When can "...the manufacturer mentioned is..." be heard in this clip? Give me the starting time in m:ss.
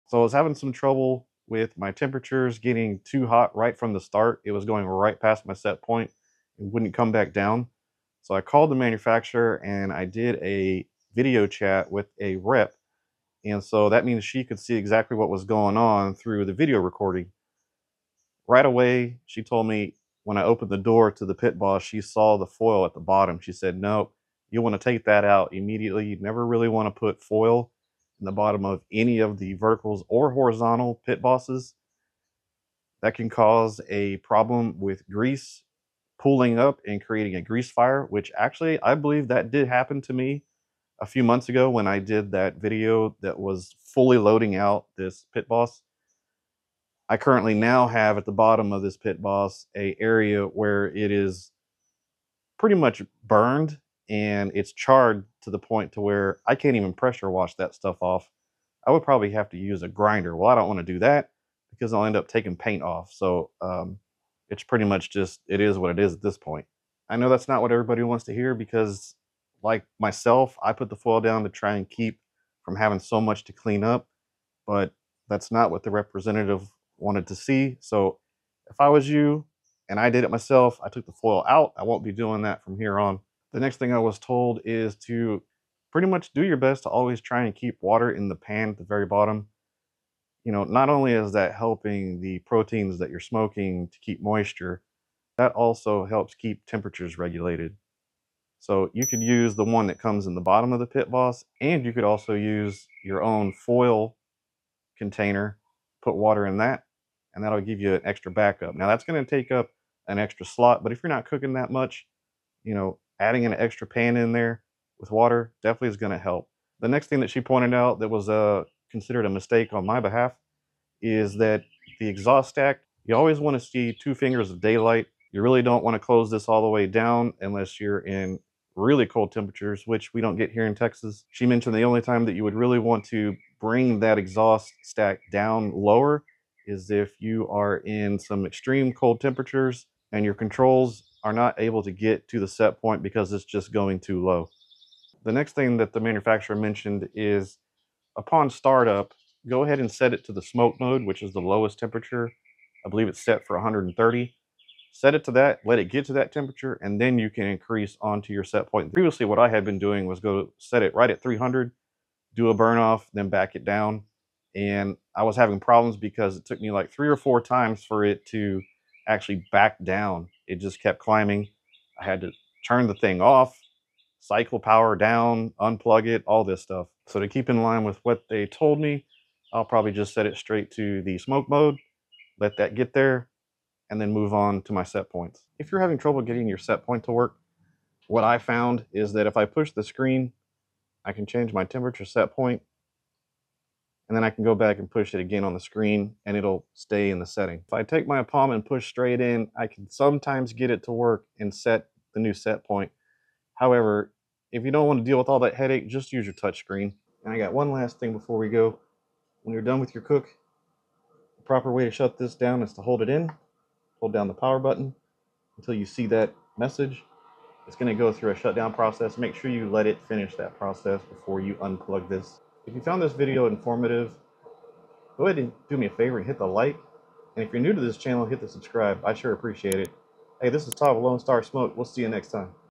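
2:25.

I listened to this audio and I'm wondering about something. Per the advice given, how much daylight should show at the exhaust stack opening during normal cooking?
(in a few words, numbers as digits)
Two fingers.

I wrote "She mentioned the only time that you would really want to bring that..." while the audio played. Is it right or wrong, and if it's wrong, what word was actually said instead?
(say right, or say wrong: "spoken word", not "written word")
right.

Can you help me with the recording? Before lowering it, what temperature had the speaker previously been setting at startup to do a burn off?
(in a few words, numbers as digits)
300.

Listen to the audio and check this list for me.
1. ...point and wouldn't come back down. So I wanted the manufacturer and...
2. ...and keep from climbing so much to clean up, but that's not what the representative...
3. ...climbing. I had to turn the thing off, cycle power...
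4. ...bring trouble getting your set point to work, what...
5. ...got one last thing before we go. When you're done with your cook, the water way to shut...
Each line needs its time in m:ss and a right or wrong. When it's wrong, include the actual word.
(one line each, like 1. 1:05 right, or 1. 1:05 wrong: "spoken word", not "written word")
1. 0:05 wrong: "called", not "wanted"
2. 1:11 wrong: "having", not "climbing"
3. 2:50 right
4. 3:05 wrong: "having", not "bring"
5. 3:27 wrong: "proper", not "water".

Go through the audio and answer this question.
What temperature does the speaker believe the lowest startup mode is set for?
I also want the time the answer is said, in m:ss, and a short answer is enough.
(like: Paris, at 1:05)
130, at 2:33.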